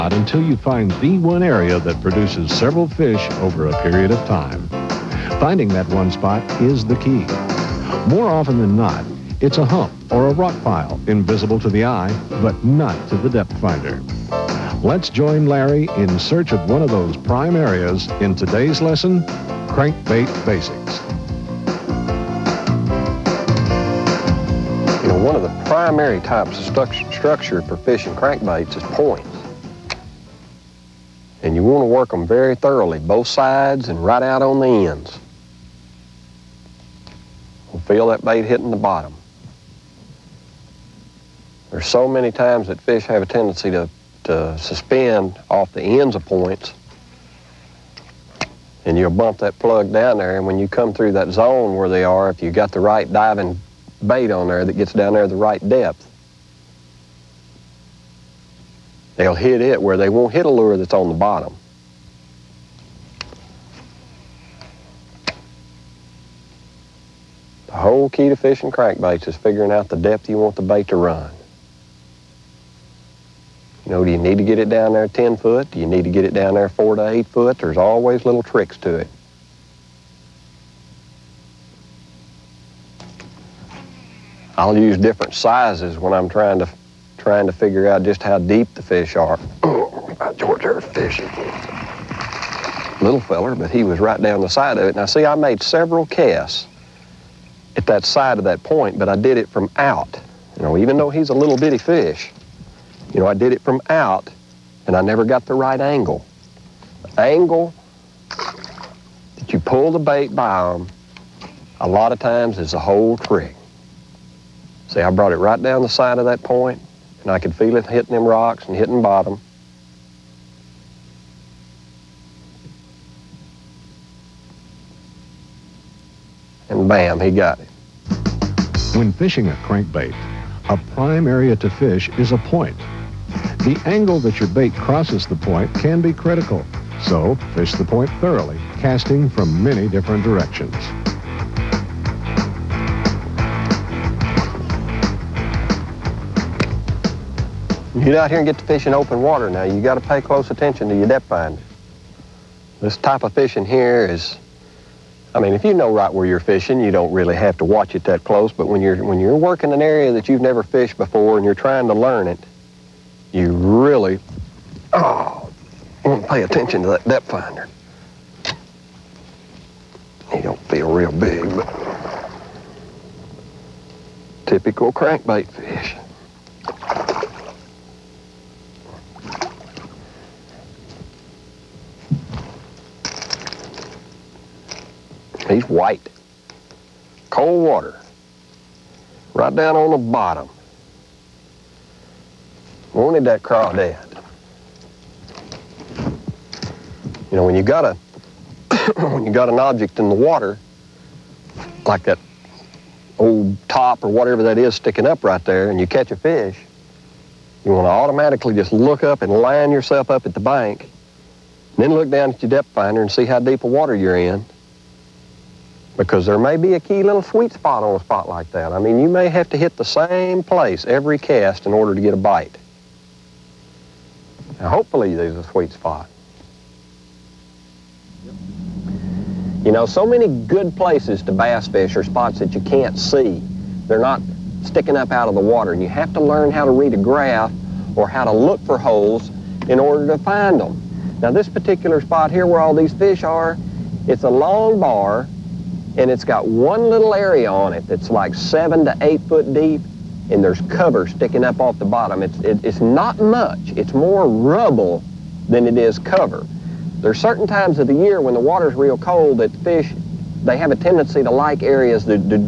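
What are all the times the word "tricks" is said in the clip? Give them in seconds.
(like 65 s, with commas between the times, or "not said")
78 s, 113 s.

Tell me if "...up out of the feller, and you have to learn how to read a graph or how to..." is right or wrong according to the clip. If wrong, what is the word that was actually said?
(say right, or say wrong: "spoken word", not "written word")
wrong: "water", not "feller".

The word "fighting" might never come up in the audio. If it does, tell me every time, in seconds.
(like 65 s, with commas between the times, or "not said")
not said.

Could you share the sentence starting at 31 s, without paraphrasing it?
And you want to work them very thoroughly, both sides and right out on the ends.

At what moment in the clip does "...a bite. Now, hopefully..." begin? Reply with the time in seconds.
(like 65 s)
222 s.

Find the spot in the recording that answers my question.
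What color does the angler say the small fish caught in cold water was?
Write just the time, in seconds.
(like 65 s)
185 s.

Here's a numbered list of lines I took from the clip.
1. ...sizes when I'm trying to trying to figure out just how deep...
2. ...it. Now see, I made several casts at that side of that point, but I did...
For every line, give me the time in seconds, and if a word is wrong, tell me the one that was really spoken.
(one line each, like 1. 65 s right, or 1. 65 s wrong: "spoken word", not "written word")
1. 85 s right
2. 94 s right.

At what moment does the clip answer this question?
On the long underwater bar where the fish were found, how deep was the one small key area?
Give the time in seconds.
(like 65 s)
248 s.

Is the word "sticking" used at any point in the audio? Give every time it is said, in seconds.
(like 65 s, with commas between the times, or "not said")
204 s, 234 s, 251 s.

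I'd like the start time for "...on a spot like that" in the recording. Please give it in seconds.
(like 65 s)
217 s.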